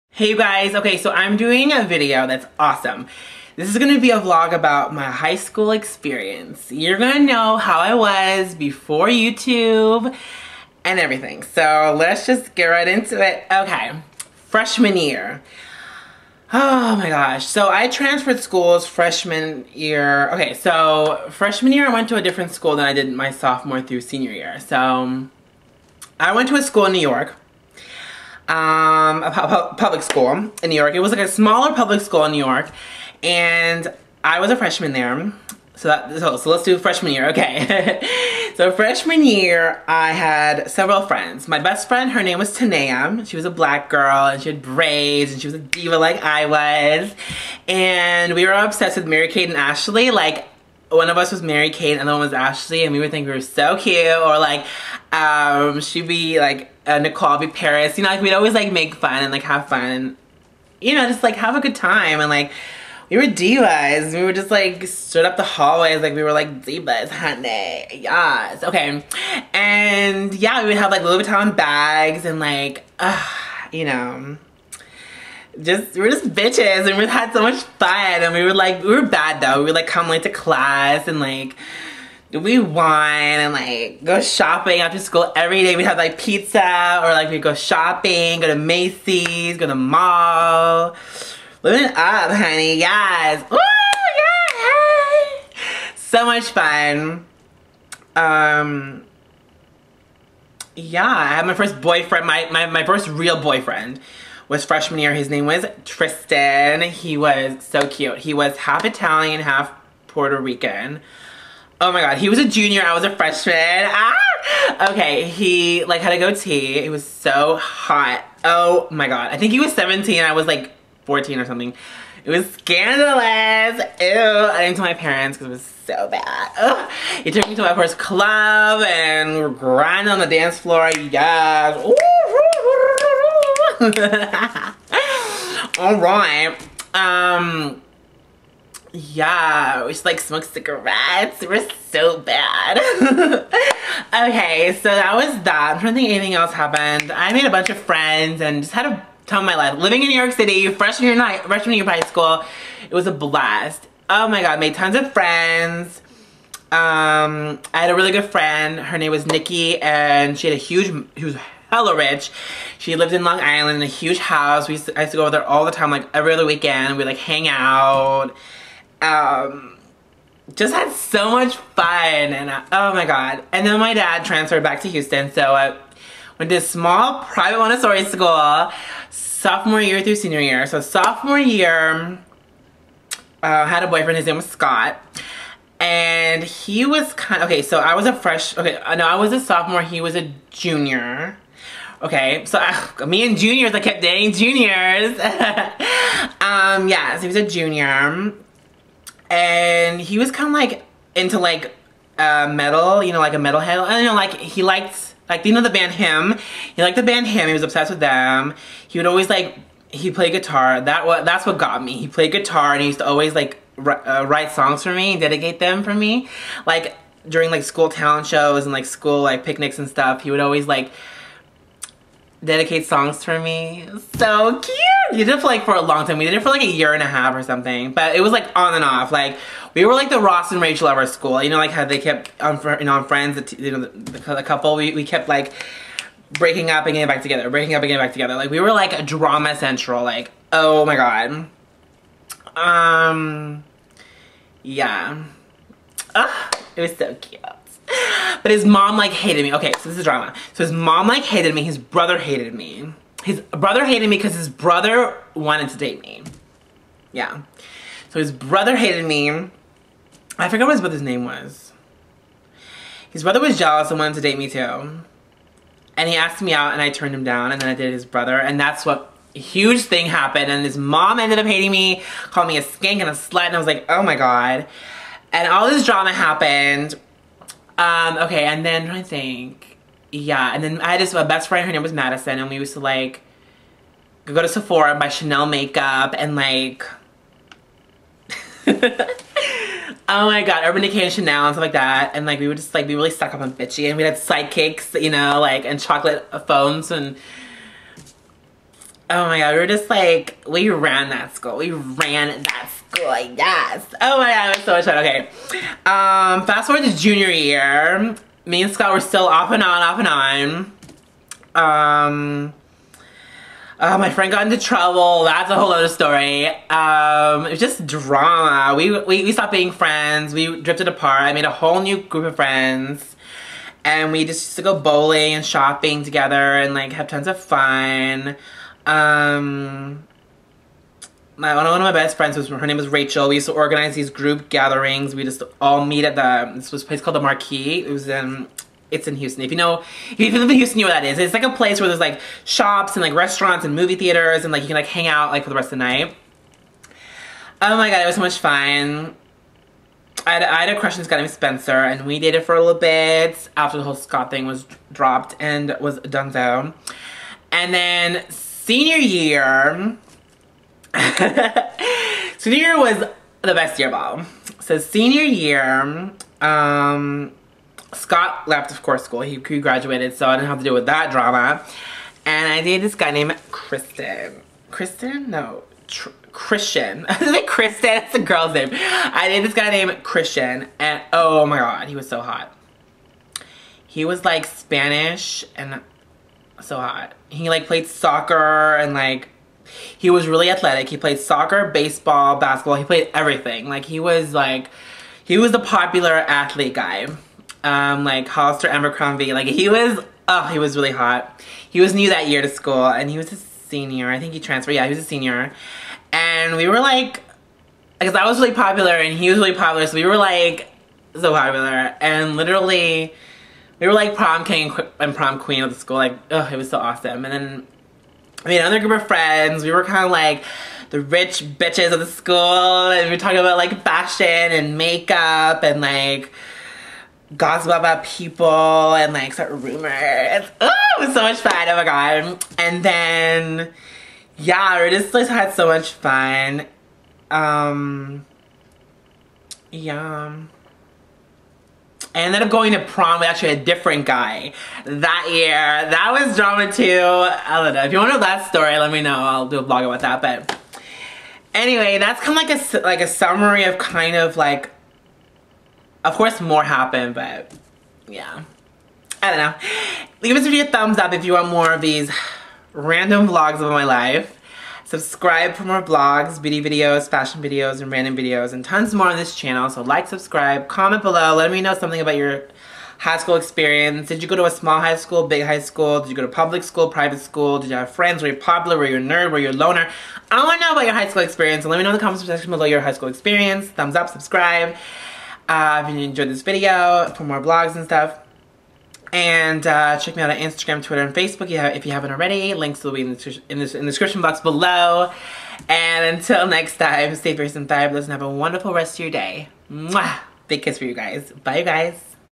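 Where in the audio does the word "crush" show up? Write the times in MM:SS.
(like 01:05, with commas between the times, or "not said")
05:50.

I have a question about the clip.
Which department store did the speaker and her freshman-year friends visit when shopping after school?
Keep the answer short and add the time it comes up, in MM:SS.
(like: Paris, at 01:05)
Macy's, at 01:28.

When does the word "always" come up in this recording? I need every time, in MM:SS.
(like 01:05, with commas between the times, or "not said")
00:58, 03:29, 03:33, 03:40.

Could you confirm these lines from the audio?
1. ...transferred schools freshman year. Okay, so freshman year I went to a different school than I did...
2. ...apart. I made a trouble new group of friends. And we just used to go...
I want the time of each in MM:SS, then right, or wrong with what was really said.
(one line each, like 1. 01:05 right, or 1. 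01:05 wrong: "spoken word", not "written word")
1. 00:17 right
2. 05:20 wrong: "whole", not "trouble".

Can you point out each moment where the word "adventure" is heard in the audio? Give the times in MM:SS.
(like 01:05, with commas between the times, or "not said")
not said.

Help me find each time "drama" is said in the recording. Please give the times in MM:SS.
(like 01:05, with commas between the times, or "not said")
03:59, 04:10, 04:35, 05:17, 06:11, 07:26.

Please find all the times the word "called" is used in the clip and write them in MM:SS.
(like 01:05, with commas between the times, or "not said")
04:32, 05:37.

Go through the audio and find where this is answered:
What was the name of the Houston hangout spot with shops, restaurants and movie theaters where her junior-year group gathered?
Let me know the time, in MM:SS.
05:37.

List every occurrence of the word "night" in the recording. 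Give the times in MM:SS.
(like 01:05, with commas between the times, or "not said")
02:31, 05:45.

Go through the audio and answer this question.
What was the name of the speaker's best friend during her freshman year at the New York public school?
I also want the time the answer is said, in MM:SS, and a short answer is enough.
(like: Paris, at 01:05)
Tanea, at 00:42.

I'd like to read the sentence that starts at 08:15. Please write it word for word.
And until next time, stay fierce and fabulous and have a wonderful rest of your day.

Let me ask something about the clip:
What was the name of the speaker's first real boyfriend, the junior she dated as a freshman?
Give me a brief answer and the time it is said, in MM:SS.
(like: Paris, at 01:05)
Tristan, at 01:45.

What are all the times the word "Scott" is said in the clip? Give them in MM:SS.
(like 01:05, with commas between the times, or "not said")
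03:04, 05:08, 05:53, 06:07.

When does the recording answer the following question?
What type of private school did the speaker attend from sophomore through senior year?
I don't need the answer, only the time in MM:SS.
02:57.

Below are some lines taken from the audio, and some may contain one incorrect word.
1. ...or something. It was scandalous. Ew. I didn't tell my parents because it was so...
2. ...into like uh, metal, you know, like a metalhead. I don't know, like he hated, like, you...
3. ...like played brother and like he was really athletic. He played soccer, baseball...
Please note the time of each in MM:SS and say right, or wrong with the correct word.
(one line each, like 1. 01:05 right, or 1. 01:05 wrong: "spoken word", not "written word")
1. 02:01 right
2. 03:21 wrong: "liked", not "hated"
3. 06:27 wrong: "soccer", not "brother".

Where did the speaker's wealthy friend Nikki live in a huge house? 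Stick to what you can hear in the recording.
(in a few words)
Long Island.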